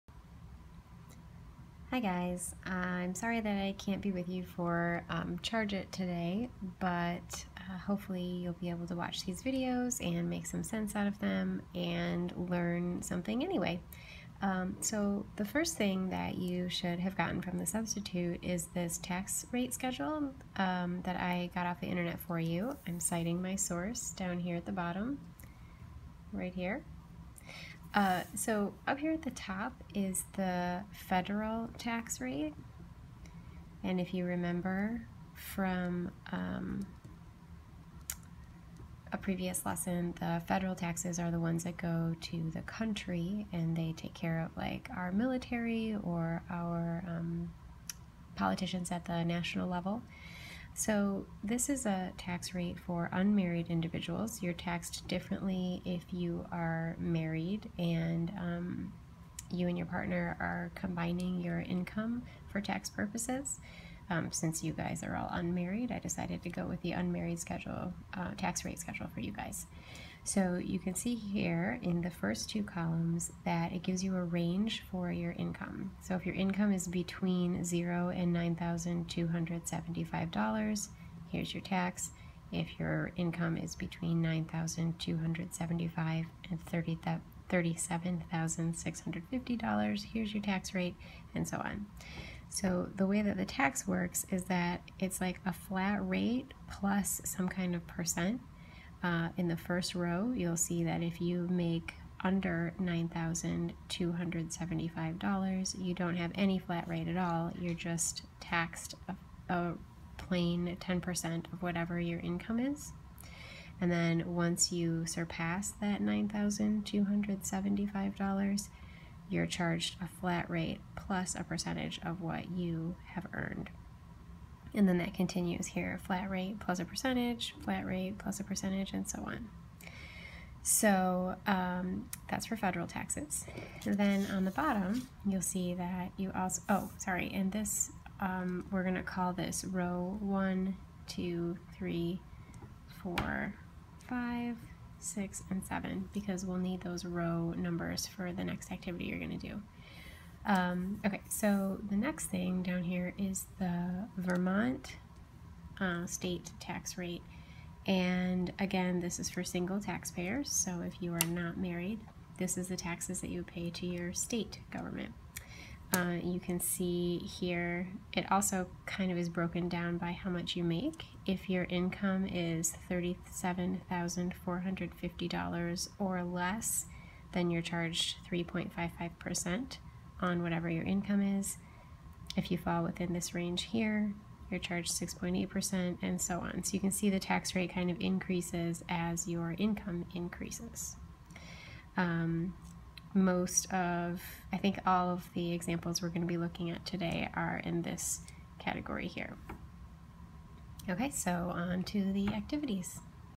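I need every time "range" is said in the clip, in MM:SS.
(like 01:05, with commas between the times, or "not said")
01:14, 03:03.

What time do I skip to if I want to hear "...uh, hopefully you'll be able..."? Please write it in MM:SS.
00:07.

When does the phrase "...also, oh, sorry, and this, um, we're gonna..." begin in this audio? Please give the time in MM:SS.
02:16.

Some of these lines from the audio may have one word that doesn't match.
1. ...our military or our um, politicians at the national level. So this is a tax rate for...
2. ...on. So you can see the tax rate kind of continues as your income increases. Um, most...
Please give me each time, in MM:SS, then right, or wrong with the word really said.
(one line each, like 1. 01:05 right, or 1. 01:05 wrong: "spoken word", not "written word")
1. 00:44 right
2. 03:06 wrong: "increases", not "continues".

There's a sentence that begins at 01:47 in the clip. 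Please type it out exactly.
You're just taxed a, a plain 10% of whatever your income is.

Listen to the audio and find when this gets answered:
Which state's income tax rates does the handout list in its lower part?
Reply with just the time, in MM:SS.
02:34.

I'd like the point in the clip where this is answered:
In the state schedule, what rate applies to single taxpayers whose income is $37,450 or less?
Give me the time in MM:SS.
02:58.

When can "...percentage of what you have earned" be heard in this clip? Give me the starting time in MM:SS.
02:01.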